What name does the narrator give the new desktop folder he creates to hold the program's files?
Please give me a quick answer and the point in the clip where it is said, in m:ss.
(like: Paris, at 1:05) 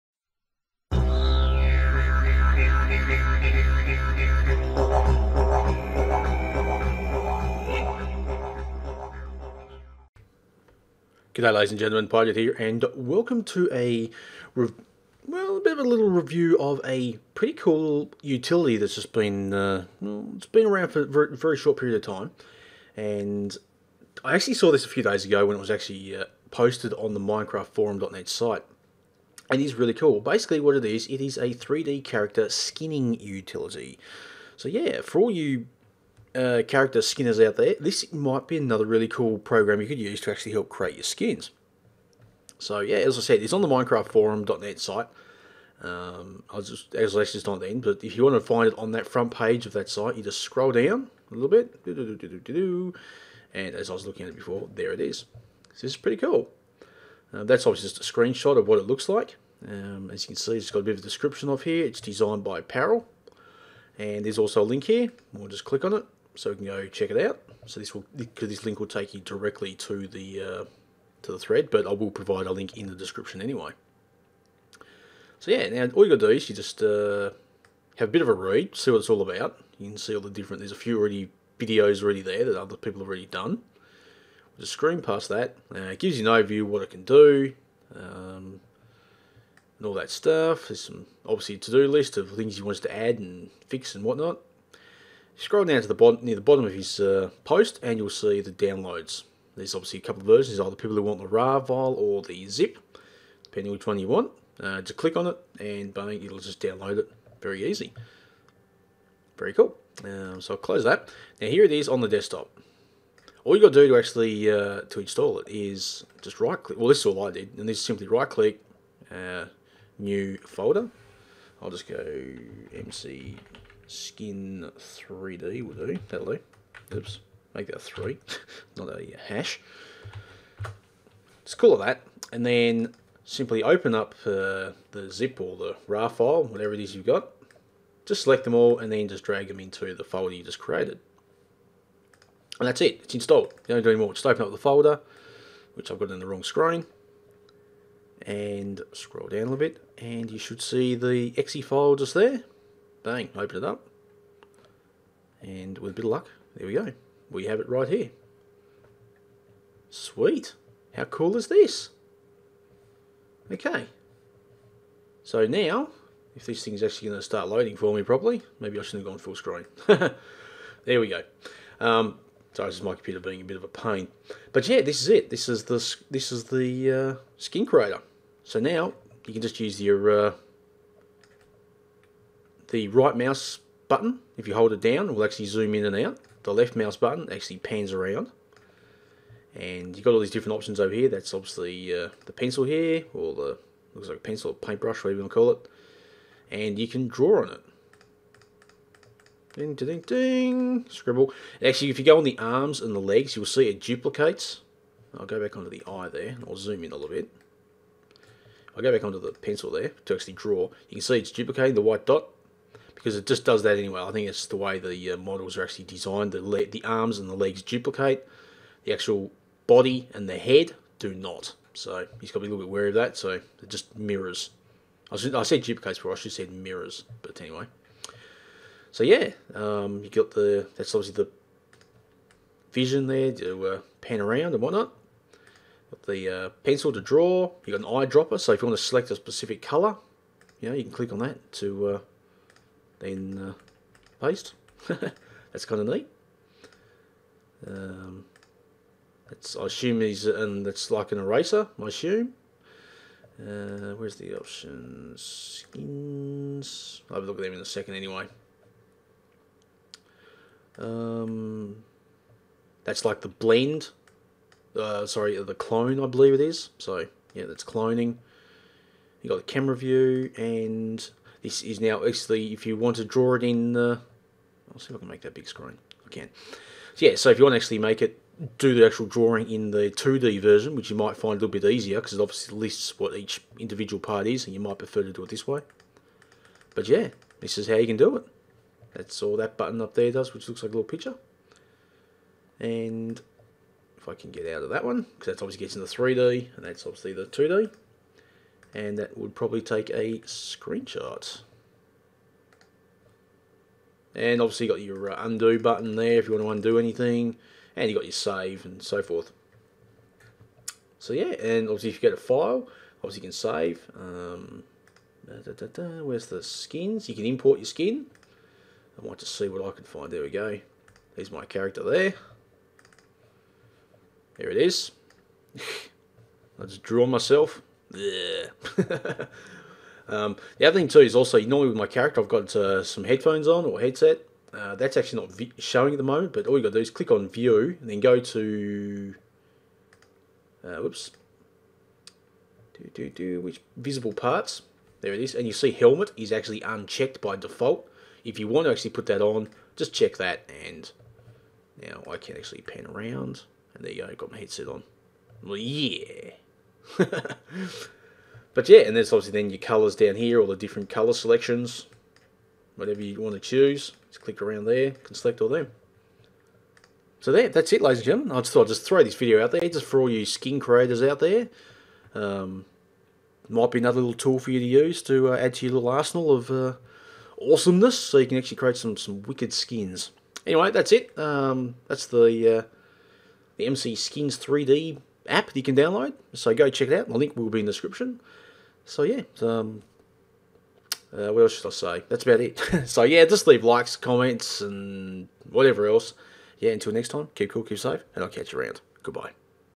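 MC skin 3D, at 2:02.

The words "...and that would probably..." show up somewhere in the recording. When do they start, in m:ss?
4:58.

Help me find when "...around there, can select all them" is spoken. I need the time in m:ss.
6:04.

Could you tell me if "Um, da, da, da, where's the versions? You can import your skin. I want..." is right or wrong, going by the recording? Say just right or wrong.
wrong.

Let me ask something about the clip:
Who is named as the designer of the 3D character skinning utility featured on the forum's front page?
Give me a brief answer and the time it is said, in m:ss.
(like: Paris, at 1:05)
Paril, at 1:02.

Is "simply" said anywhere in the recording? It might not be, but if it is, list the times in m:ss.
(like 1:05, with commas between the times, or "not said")
1:57, 2:13.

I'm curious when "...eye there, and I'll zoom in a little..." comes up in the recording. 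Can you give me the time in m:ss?
3:25.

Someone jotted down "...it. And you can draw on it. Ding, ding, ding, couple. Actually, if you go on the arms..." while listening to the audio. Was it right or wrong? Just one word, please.
wrong.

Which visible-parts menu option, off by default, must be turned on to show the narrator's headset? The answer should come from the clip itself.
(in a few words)
Helmet.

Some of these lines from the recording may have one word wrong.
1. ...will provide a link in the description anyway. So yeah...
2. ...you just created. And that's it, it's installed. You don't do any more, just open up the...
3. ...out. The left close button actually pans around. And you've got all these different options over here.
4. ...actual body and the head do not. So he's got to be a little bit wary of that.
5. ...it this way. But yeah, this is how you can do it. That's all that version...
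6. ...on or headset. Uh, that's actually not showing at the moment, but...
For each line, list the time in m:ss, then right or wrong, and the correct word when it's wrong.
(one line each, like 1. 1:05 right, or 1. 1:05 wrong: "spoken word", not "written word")
1. 1:11 right
2. 2:20 right
3. 3:05 wrong: "mouse", not "close"
4. 3:38 right
5. 4:45 wrong: "button", not "version"
6. 5:33 right.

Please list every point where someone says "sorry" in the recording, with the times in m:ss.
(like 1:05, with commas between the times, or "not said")
2:52, 4:25.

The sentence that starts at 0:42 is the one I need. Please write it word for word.
So yeah, as I said, it's on the MinecraftForum.net site.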